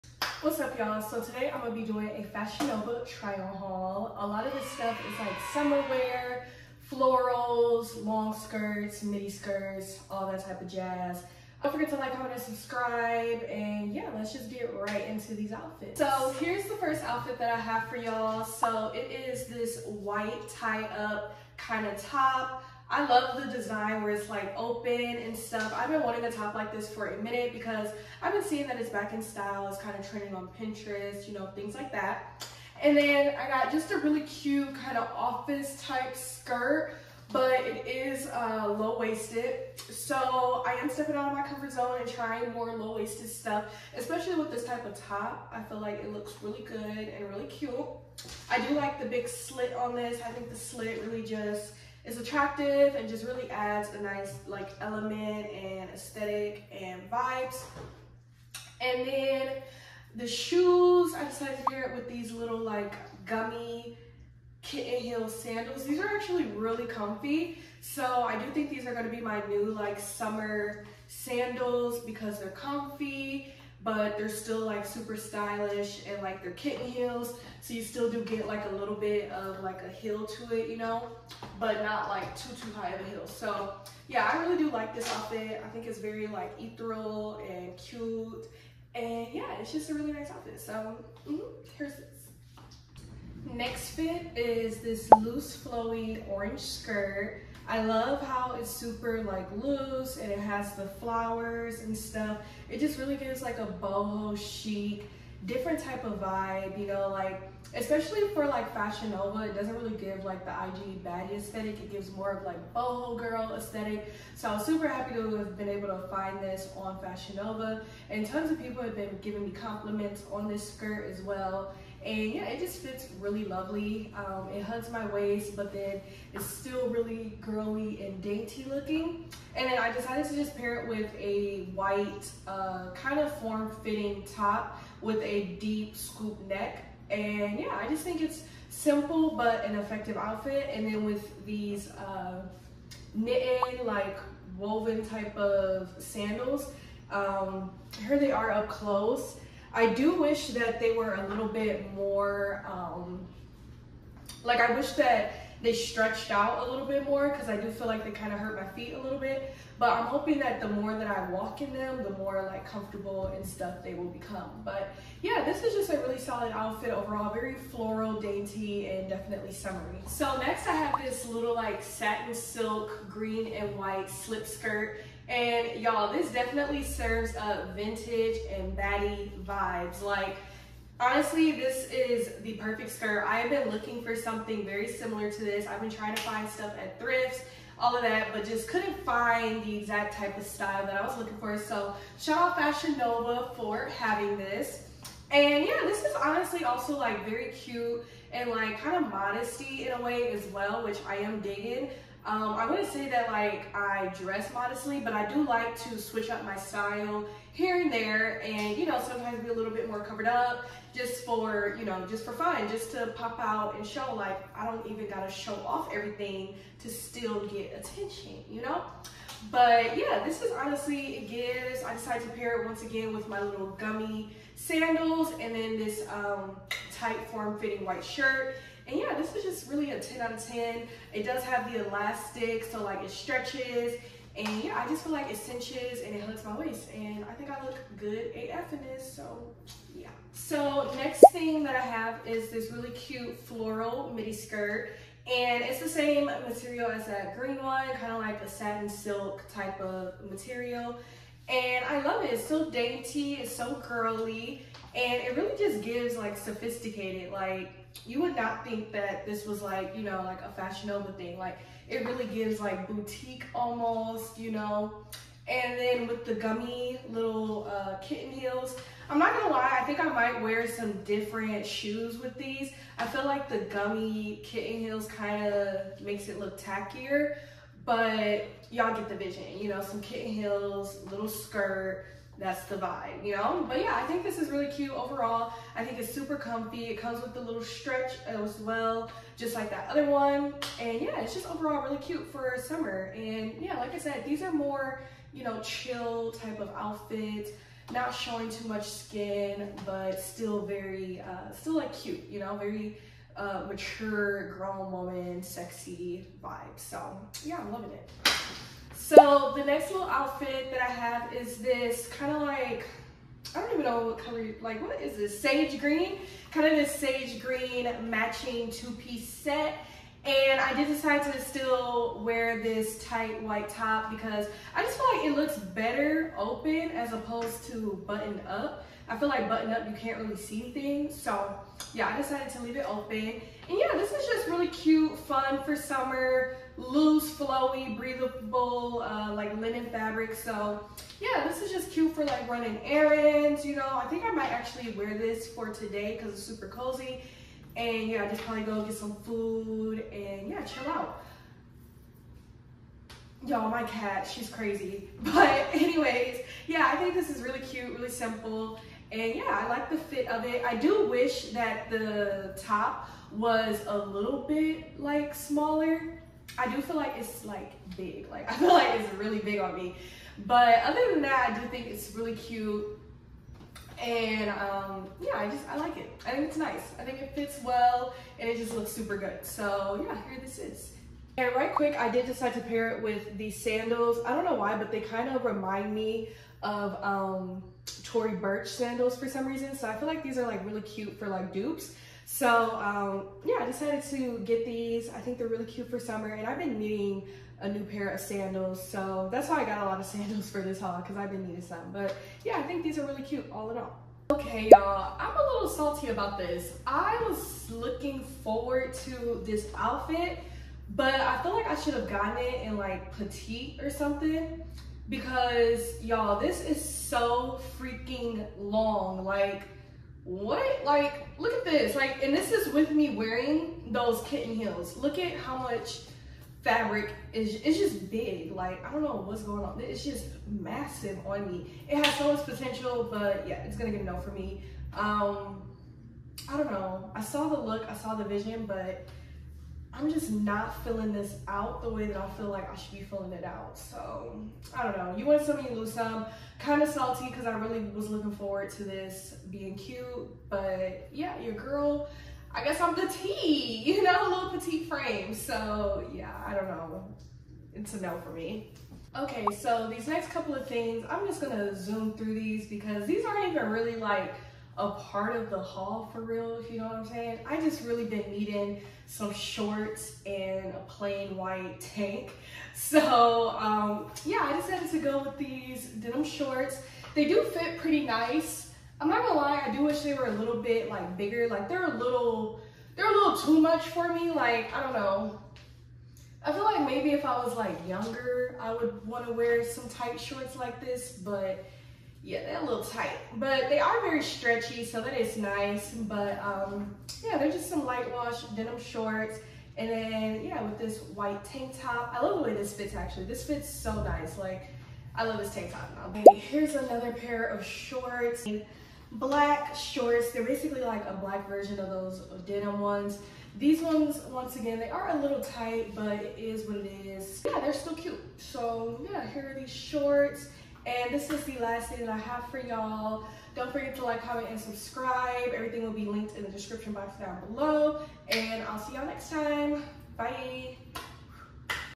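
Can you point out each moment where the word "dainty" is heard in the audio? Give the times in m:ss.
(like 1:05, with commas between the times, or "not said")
2:08, 2:48, 4:12.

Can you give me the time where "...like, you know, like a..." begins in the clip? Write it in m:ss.
4:19.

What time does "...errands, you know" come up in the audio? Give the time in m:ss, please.
5:42.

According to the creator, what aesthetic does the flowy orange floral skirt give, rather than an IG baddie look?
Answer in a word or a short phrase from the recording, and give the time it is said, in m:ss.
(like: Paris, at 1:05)
boho chic, at 1:43.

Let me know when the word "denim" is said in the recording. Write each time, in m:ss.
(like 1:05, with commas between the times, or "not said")
7:55, 8:18, 8:32.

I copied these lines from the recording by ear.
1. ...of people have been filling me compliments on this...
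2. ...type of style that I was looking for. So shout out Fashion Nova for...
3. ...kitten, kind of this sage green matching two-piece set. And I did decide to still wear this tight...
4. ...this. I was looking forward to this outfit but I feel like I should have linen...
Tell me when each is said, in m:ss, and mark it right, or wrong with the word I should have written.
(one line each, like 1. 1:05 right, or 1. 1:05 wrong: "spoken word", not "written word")
1. 1:58 wrong: "giving", not "filling"
2. 3:10 right
3. 5:15 wrong: "green", not "kitten"
4. 6:46 wrong: "gotten", not "linen".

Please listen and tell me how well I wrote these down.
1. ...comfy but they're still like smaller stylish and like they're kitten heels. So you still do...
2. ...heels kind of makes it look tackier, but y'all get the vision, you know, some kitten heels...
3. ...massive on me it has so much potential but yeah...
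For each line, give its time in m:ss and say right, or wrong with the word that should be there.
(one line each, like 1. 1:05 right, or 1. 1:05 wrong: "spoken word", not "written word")
1. 1:12 wrong: "super", not "smaller"
2. 4:34 right
3. 7:10 right.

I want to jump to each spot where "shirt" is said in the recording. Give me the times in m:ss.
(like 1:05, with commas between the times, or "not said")
3:48.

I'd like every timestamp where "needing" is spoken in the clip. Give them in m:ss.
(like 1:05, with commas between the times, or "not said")
6:36, 6:41, 7:48.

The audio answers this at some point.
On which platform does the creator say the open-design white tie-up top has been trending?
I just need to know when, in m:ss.
0:30.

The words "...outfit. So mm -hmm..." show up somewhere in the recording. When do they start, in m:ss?
1:30.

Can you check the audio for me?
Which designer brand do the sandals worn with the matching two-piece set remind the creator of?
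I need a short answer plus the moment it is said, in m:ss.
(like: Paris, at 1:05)
Tory Burch, at 6:28.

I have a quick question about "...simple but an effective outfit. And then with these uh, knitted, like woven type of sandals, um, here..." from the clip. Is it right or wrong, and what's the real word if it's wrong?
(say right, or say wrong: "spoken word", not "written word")
right.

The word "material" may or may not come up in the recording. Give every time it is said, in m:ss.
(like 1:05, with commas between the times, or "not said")
4:06, 4:10.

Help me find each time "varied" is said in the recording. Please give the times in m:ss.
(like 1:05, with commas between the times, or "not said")
not said.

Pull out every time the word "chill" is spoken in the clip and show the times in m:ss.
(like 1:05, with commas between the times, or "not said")
4:55, 5:50.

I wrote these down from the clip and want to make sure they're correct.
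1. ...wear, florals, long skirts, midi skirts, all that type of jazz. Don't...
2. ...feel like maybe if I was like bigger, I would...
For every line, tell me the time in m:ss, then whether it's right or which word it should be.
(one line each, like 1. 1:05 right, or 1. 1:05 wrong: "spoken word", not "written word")
1. 0:05 right
2. 8:06 wrong: "younger", not "bigger".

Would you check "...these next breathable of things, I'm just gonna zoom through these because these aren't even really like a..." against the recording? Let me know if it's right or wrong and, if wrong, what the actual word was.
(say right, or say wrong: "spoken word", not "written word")
wrong: "couple", not "breathable".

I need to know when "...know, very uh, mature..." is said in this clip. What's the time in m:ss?
5:02.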